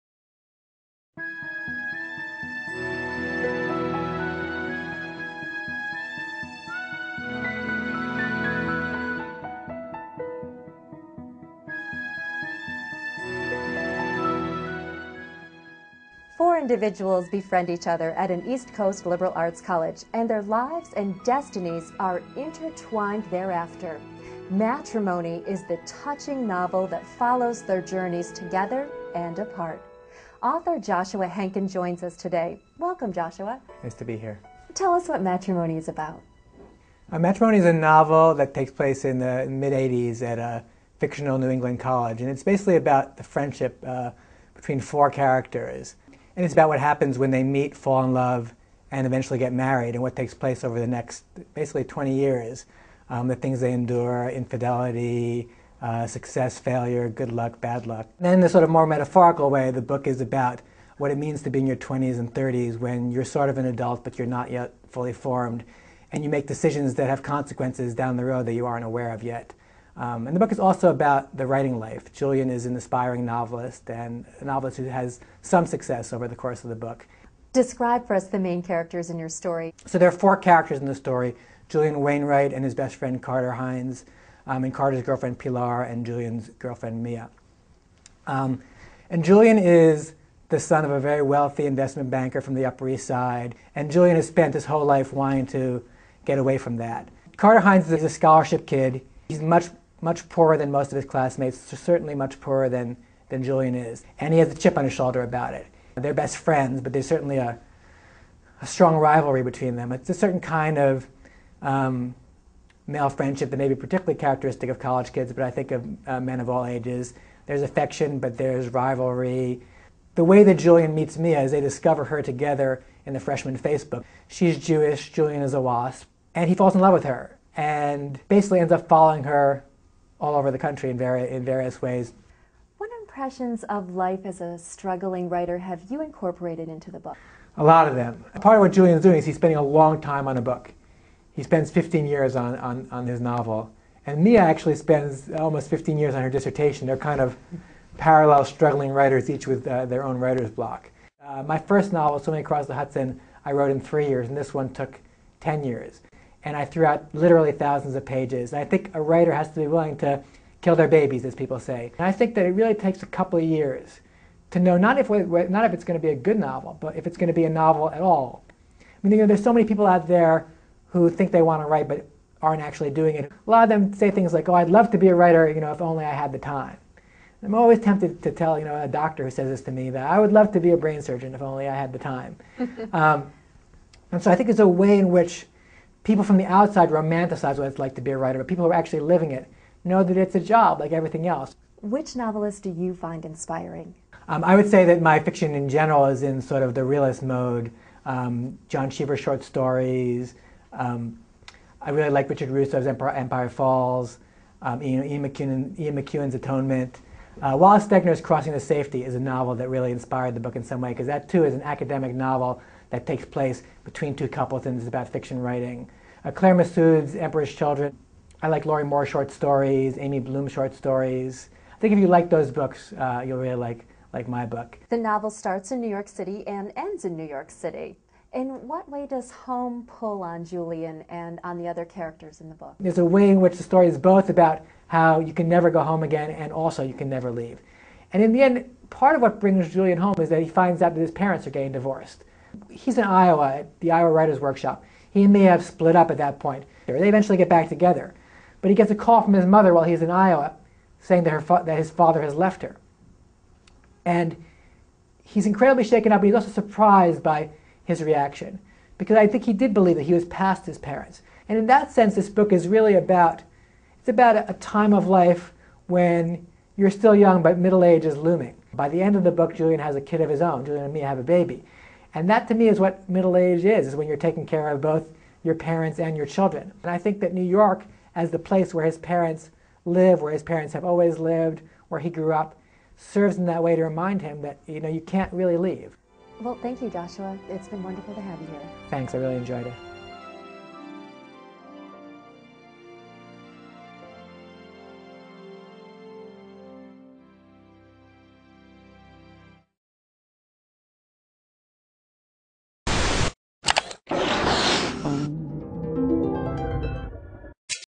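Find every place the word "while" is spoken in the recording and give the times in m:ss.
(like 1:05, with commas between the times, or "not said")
4:09.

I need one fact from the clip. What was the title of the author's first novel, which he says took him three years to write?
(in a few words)
Swimming Across the Hudson.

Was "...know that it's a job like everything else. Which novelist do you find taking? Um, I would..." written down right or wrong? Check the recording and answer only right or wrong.
wrong.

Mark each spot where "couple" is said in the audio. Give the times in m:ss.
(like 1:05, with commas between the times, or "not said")
2:43, 3:34.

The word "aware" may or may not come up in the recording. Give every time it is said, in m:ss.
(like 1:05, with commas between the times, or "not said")
1:08.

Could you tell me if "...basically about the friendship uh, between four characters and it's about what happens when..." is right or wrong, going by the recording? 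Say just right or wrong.
right.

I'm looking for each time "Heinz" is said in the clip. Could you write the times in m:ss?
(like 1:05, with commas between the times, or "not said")
1:23, 1:37.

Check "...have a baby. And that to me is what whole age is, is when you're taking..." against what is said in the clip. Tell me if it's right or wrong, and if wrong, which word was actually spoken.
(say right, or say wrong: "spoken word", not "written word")
wrong: "middle", not "whole".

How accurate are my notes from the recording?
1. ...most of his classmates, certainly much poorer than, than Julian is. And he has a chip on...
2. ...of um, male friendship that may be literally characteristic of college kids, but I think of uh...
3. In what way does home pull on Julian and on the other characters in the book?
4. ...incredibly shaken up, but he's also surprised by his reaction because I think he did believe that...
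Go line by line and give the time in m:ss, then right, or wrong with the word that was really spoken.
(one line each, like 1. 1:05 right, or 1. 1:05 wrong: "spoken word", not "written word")
1. 1:40 right
2. 1:50 wrong: "particularly", not "literally"
3. 3:48 right
4. 4:15 right.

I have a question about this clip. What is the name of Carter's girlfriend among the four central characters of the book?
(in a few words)
Pilar.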